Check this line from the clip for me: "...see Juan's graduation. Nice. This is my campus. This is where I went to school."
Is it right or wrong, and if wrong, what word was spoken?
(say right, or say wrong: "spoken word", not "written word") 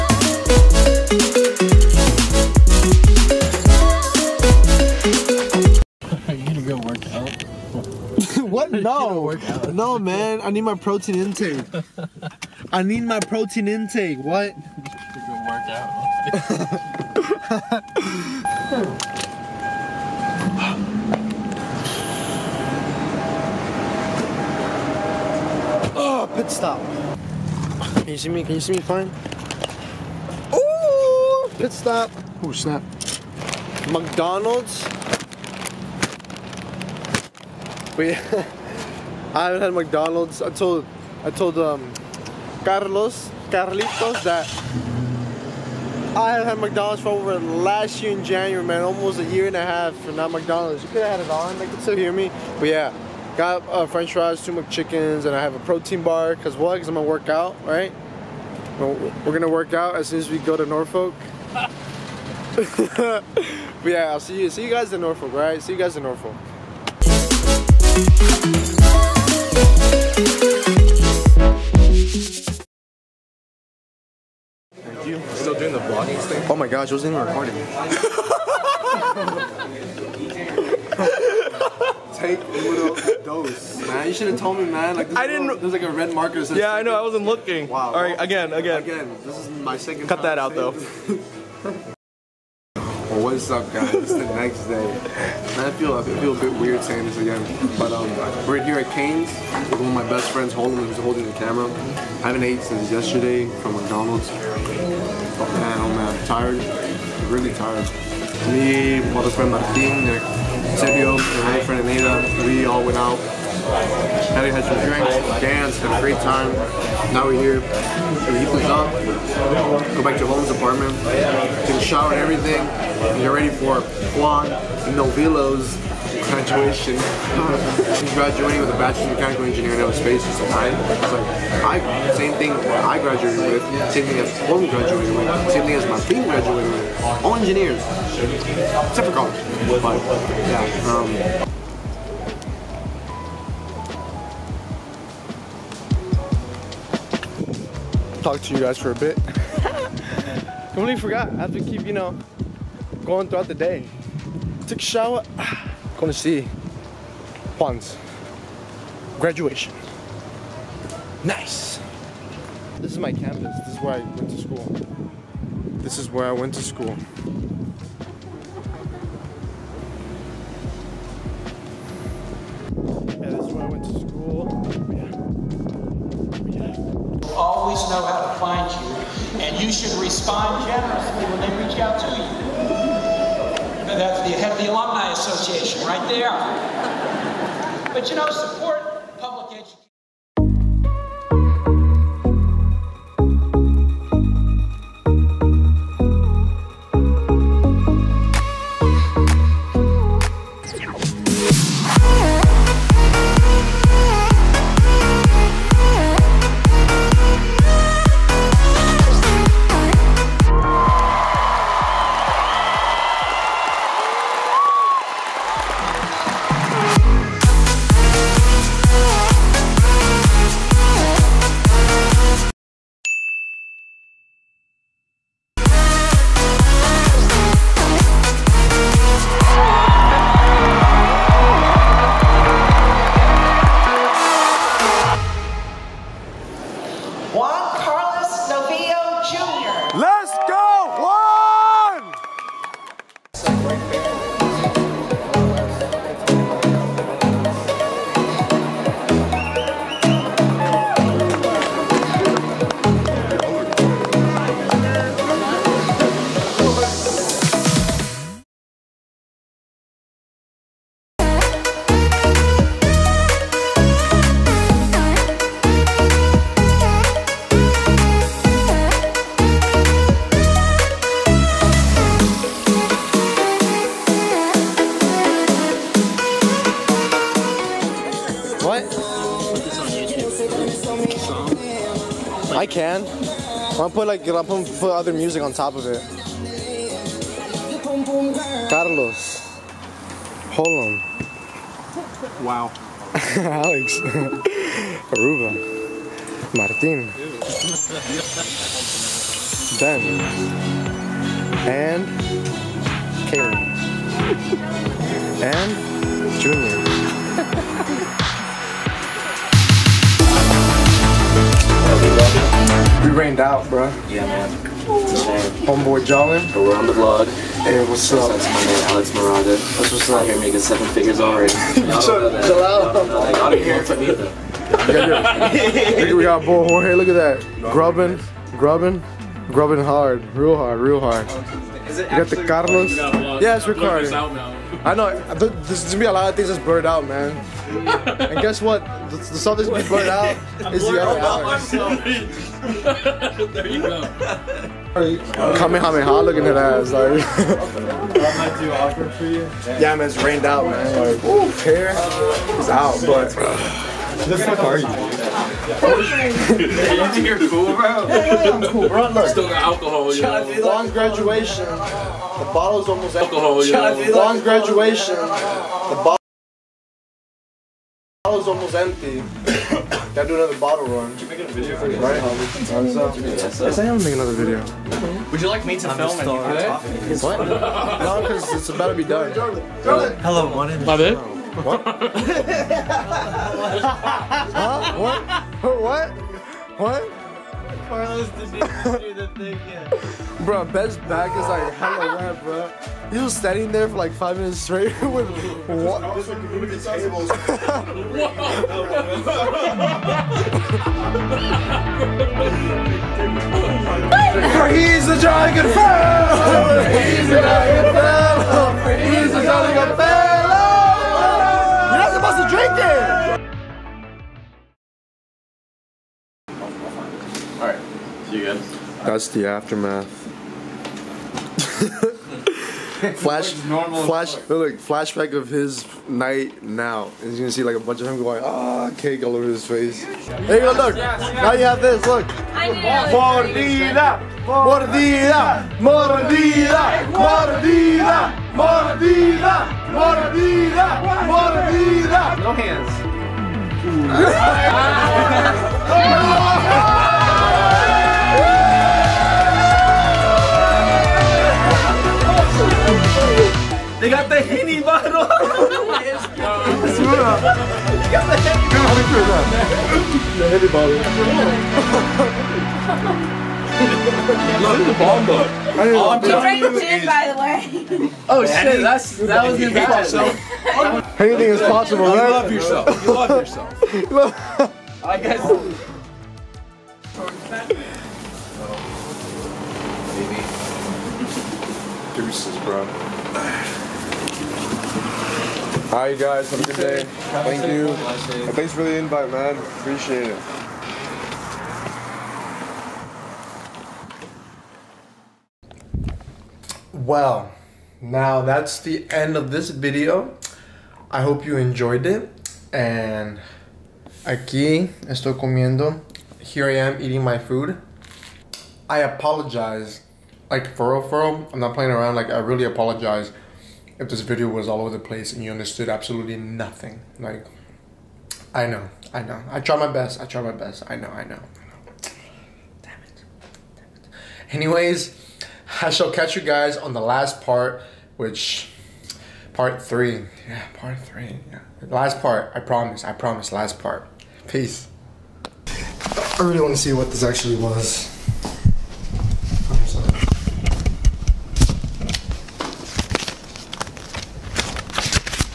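right.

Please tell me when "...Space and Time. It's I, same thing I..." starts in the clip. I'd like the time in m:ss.
2:09.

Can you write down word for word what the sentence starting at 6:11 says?
Did you make a video for right?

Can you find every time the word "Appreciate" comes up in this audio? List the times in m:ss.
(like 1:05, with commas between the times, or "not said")
8:09.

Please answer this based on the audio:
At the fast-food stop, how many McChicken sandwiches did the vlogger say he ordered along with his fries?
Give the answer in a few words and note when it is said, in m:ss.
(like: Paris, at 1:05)
2, at 0:54.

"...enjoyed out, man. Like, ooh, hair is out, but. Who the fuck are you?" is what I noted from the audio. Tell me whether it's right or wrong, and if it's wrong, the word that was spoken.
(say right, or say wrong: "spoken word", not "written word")
wrong: "rained", not "enjoyed".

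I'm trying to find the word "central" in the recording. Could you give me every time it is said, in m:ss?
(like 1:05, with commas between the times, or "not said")
not said.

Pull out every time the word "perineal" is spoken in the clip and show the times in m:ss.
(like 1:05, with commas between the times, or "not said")
not said.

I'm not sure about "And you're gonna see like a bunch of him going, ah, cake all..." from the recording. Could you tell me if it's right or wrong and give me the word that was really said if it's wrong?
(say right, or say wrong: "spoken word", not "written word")
right.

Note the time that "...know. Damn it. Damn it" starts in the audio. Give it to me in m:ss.
8:41.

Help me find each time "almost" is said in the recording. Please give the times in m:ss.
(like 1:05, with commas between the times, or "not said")
0:48, 6:02, 6:08.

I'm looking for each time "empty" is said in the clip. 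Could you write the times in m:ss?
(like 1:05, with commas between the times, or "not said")
6:03, 6:08.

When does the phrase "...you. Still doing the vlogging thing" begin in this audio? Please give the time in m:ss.
1:15.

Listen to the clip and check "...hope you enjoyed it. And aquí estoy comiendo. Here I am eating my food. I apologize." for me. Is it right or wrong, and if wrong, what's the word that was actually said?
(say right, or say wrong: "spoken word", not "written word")
right.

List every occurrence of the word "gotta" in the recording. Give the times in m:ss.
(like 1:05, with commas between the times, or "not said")
5:23, 6:10.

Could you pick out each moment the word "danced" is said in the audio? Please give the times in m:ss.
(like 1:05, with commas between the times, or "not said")
1:55.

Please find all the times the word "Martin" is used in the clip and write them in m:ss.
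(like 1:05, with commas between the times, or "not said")
1:49, 4:56.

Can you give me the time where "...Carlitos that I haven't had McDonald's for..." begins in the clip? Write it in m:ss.
0:43.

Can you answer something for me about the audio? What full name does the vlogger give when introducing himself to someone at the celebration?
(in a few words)
Alex Moraga.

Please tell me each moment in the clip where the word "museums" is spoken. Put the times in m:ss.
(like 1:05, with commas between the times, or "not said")
not said.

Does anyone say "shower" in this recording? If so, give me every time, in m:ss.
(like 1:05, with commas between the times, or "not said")
2:01, 2:34.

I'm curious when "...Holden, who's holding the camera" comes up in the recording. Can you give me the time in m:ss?
1:40.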